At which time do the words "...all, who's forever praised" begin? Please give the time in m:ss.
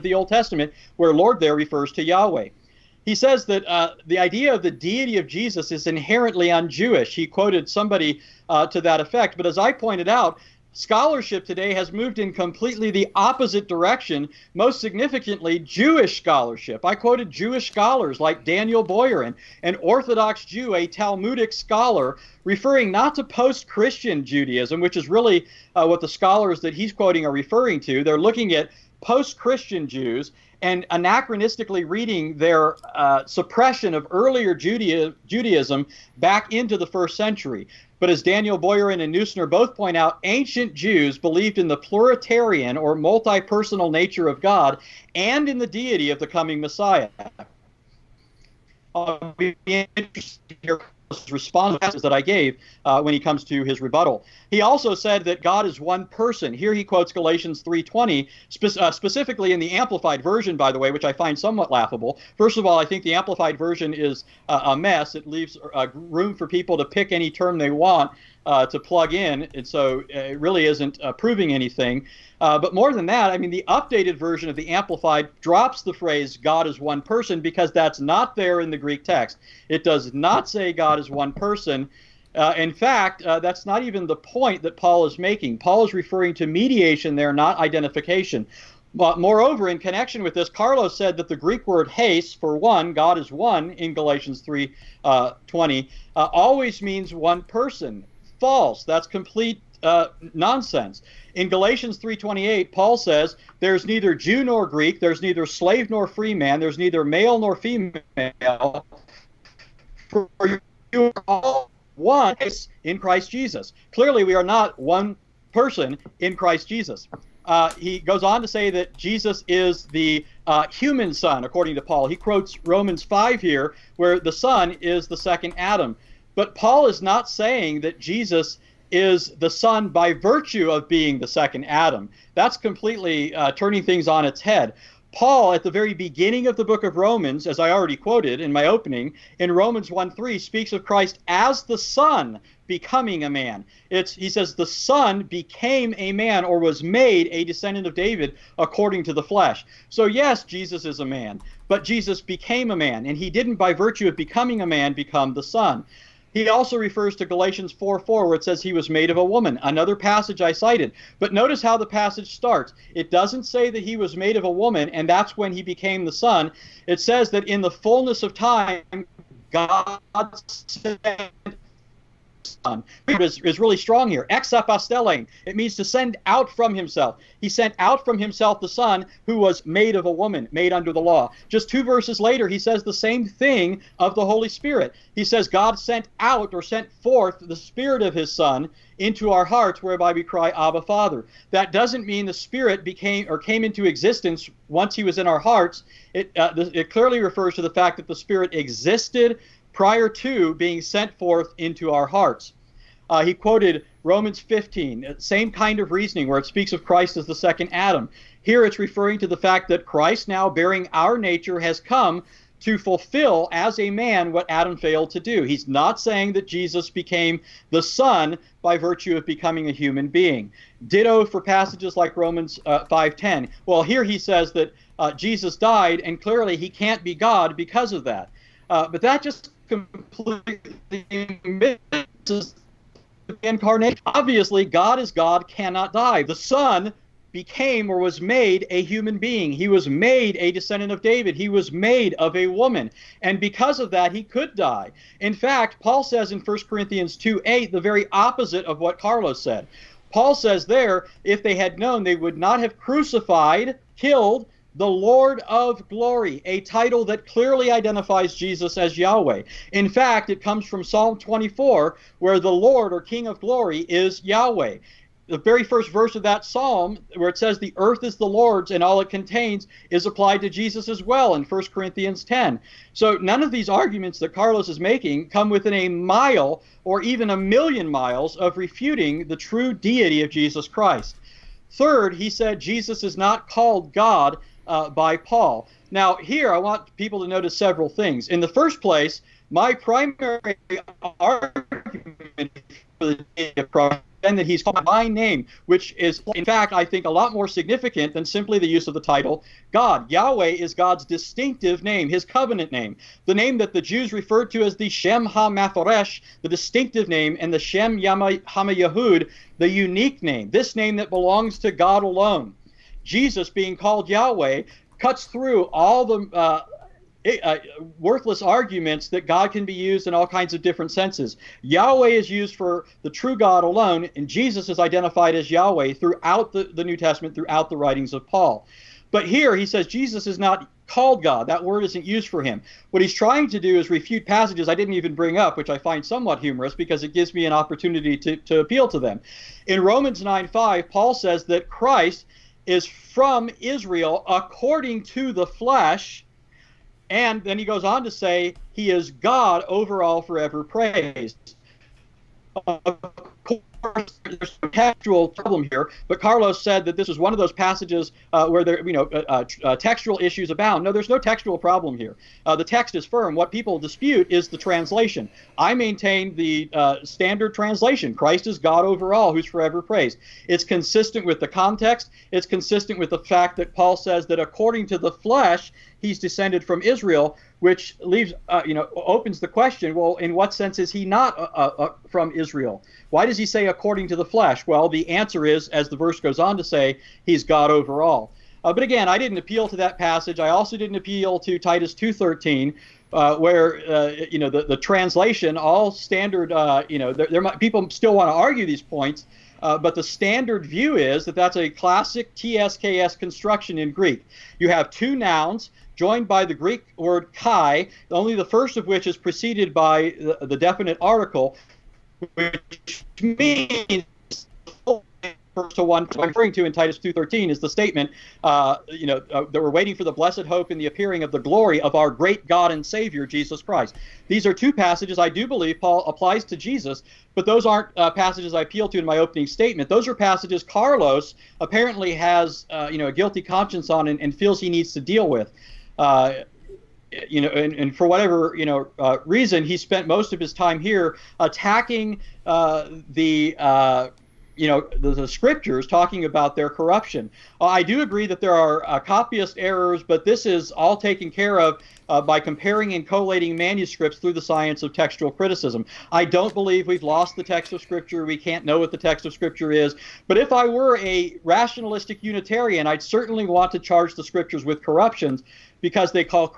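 6:09.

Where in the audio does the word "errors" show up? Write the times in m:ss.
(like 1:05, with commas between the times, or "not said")
7:29.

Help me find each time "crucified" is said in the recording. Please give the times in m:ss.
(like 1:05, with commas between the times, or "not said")
4:12.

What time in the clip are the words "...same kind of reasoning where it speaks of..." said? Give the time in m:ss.
3:25.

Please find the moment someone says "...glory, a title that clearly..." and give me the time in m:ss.
4:15.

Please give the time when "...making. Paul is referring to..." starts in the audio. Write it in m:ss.
1:25.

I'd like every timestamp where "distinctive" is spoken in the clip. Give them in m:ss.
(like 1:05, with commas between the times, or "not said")
5:01, 5:06.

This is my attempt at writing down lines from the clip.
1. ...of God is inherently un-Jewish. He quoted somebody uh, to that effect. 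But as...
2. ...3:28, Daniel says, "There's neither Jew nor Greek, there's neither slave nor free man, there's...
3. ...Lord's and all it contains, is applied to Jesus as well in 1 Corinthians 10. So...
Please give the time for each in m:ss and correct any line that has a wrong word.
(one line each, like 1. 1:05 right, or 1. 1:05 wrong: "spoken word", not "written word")
1. 0:05 wrong: "Jesus", not "God"
2. 1:41 wrong: "Paul", not "Daniel"
3. 4:28 right.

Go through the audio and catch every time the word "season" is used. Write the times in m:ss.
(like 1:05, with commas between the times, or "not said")
not said.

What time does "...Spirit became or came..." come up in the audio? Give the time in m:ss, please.
3:12.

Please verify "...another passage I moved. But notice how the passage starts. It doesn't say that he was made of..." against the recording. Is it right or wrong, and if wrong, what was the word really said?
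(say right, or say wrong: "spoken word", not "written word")
wrong: "cited", not "moved".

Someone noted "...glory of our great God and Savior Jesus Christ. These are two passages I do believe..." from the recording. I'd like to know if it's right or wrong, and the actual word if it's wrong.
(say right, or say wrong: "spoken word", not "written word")
right.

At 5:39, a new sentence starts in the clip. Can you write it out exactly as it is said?
In Romans 9 5, Paul says that Christ is from Israel according to the flesh.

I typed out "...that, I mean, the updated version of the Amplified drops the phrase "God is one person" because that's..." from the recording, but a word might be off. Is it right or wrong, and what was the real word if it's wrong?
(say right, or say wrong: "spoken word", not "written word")
right.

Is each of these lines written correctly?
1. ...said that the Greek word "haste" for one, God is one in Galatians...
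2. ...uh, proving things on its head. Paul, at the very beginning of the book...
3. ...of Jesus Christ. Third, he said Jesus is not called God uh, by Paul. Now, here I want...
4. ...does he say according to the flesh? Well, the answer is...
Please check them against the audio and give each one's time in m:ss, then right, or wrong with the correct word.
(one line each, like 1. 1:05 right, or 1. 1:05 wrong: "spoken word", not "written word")
1. 1:30 right
2. 2:13 wrong: "turning", not "proving"
3. 4:40 right
4. 6:23 right.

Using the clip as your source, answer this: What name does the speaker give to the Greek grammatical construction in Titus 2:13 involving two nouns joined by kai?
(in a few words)
TSKS construction.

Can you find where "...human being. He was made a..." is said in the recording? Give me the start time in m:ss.
3:58.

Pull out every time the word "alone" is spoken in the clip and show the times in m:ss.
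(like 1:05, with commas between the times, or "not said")
5:12, 5:23.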